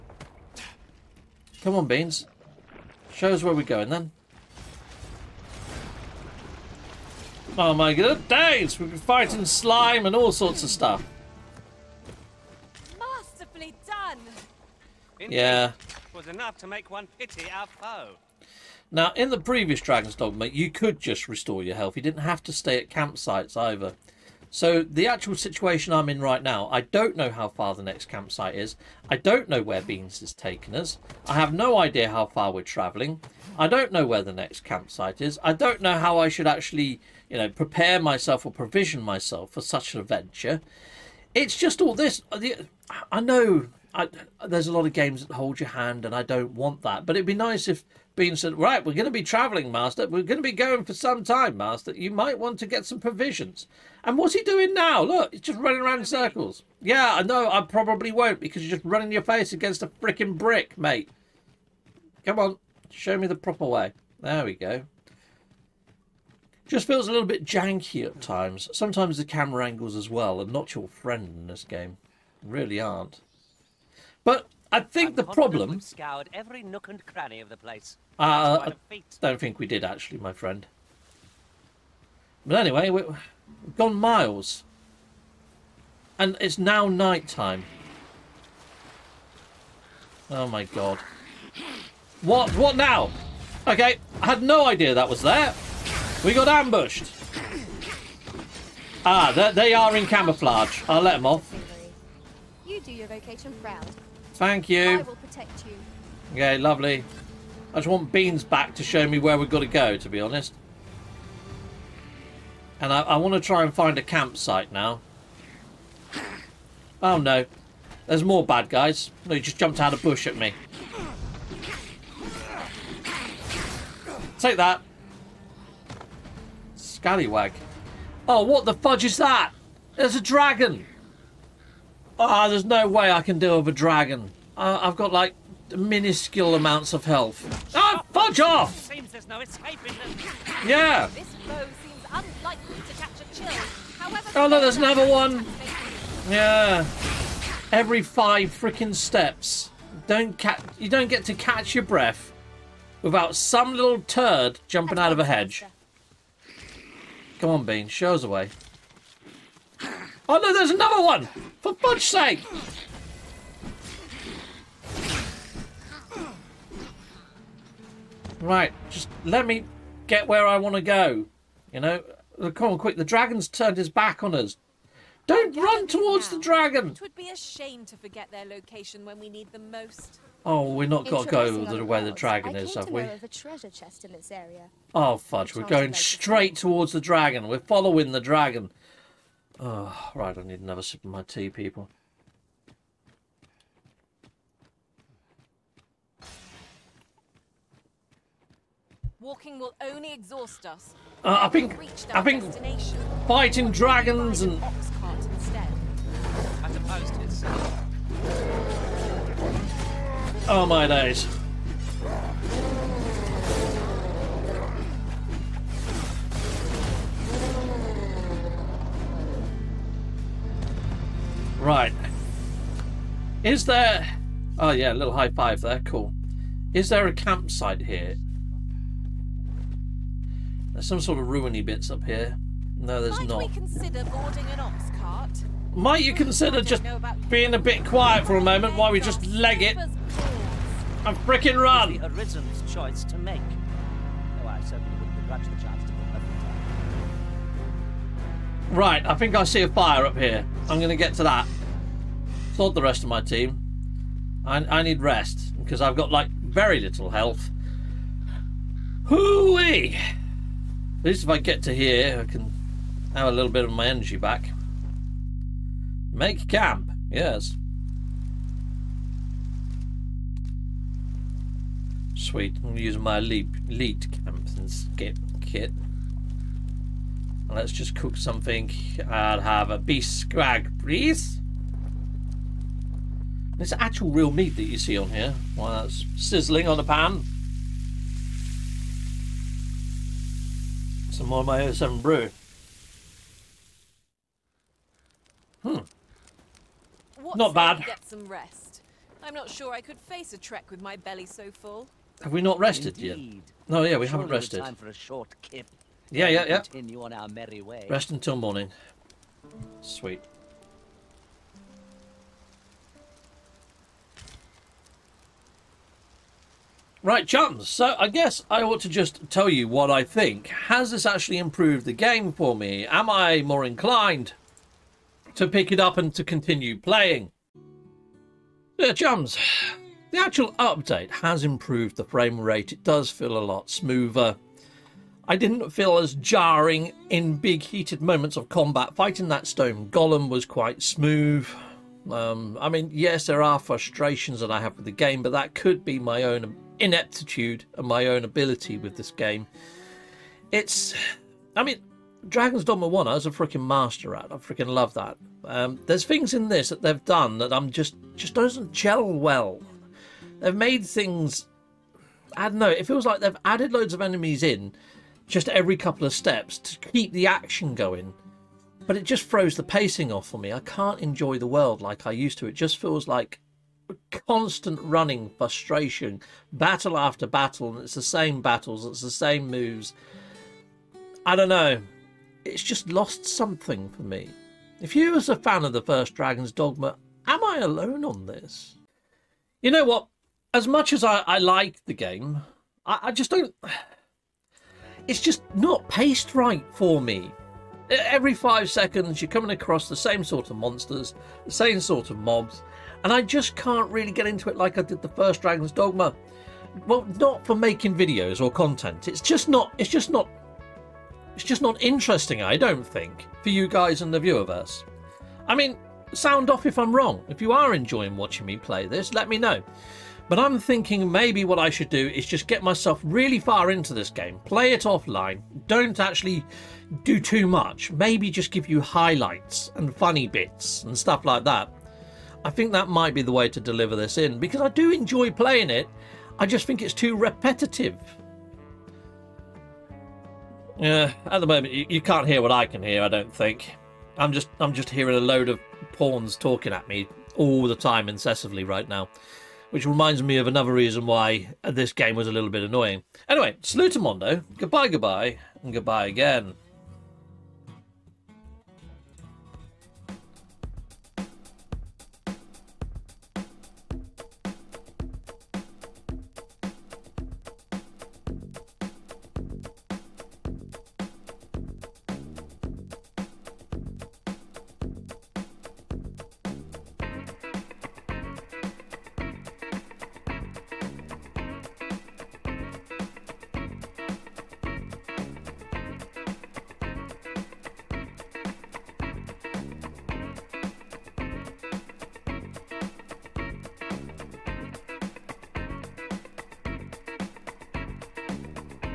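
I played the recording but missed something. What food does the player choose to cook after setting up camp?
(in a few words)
beef scrag.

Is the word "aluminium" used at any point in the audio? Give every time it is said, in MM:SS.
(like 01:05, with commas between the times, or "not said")
not said.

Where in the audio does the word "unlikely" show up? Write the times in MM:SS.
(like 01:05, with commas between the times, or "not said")
02:22.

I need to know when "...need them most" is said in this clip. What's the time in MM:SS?
02:59.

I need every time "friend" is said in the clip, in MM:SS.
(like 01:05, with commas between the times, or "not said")
01:10, 01:20.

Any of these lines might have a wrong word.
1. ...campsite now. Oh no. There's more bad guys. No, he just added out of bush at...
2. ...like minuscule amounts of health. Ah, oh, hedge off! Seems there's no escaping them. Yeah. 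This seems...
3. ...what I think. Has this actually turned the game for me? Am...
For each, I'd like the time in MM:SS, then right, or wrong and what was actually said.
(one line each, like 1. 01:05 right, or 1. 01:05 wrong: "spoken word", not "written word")
1. 01:54 wrong: "jumped", not "added"
2. 02:15 wrong: "fudge", not "hedge"
3. 05:19 wrong: "improved", not "turned".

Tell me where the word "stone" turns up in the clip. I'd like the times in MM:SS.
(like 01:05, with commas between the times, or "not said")
05:39.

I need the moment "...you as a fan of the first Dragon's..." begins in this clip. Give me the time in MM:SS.
06:24.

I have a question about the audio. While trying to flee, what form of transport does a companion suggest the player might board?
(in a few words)
ox cart.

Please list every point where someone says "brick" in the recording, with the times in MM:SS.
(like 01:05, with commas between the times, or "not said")
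01:00.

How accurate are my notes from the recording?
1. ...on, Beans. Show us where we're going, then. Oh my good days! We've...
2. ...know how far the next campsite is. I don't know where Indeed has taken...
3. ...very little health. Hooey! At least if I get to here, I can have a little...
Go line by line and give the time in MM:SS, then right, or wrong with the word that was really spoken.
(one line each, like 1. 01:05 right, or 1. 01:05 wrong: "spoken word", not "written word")
1. 00:01 right
2. 00:27 wrong: "Beans", not "Indeed"
3. 04:16 right.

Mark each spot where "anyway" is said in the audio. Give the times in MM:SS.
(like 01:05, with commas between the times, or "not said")
01:22, 07:33.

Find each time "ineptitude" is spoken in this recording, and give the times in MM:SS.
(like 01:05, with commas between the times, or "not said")
05:46.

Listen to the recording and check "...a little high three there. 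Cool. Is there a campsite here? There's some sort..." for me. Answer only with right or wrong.
wrong.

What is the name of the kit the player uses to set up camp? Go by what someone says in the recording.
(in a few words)
leap camp and skip kit.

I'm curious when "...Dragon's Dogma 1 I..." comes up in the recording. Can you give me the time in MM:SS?
05:52.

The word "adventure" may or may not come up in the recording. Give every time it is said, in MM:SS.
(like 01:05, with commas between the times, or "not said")
00:40.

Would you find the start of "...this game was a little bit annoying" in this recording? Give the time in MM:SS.
07:31.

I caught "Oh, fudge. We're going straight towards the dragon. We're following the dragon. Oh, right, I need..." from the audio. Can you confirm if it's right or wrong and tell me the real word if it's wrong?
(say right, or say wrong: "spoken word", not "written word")
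right.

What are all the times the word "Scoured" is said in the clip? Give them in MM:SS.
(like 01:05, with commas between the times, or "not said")
01:15.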